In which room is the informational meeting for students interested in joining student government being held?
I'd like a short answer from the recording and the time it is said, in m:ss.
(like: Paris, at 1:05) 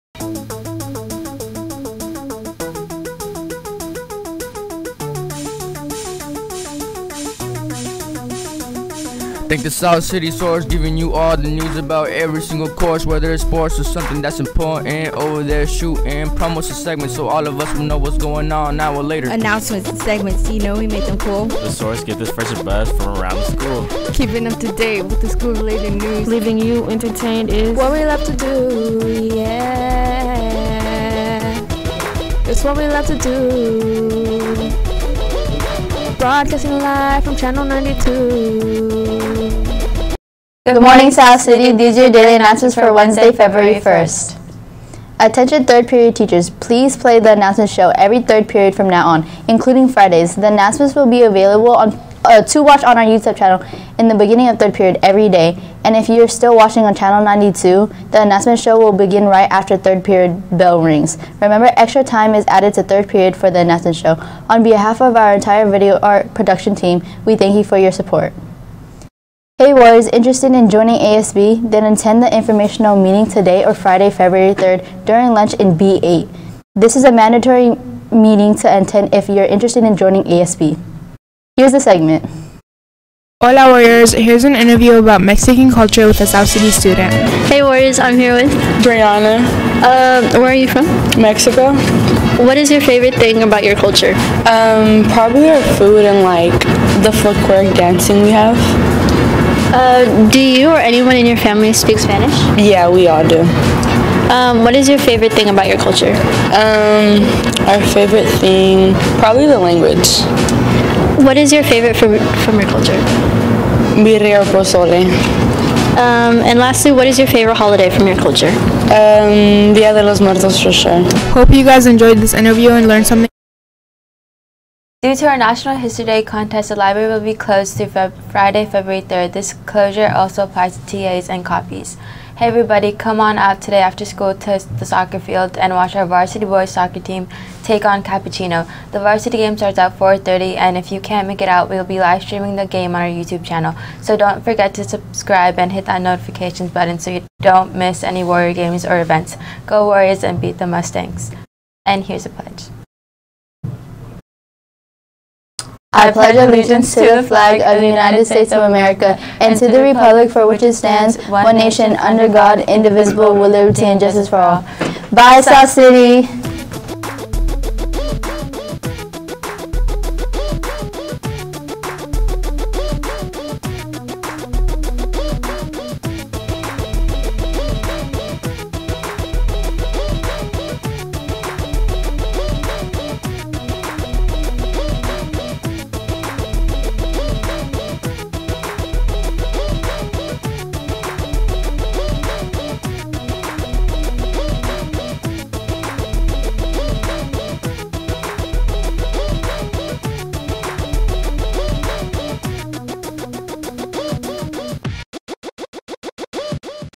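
B8, at 1:15.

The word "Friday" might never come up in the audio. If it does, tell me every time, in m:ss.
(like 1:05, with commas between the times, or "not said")
0:49, 1:13, 2:08.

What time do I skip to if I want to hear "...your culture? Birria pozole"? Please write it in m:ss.
1:52.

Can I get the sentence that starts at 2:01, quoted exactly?
Hope you guys enjoyed this interview and learned something.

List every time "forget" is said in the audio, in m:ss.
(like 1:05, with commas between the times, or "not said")
2:24.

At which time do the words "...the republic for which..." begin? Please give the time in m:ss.
2:39.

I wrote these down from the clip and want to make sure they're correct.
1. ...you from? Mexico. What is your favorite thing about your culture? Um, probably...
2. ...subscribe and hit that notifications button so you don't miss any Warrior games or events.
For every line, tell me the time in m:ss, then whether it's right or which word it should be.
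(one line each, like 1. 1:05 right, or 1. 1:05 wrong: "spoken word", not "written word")
1. 1:30 right
2. 2:24 right.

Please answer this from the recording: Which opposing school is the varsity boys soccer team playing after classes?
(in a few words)
Capuchino.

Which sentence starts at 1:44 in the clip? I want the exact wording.
Um, what is your favorite thing about your culture?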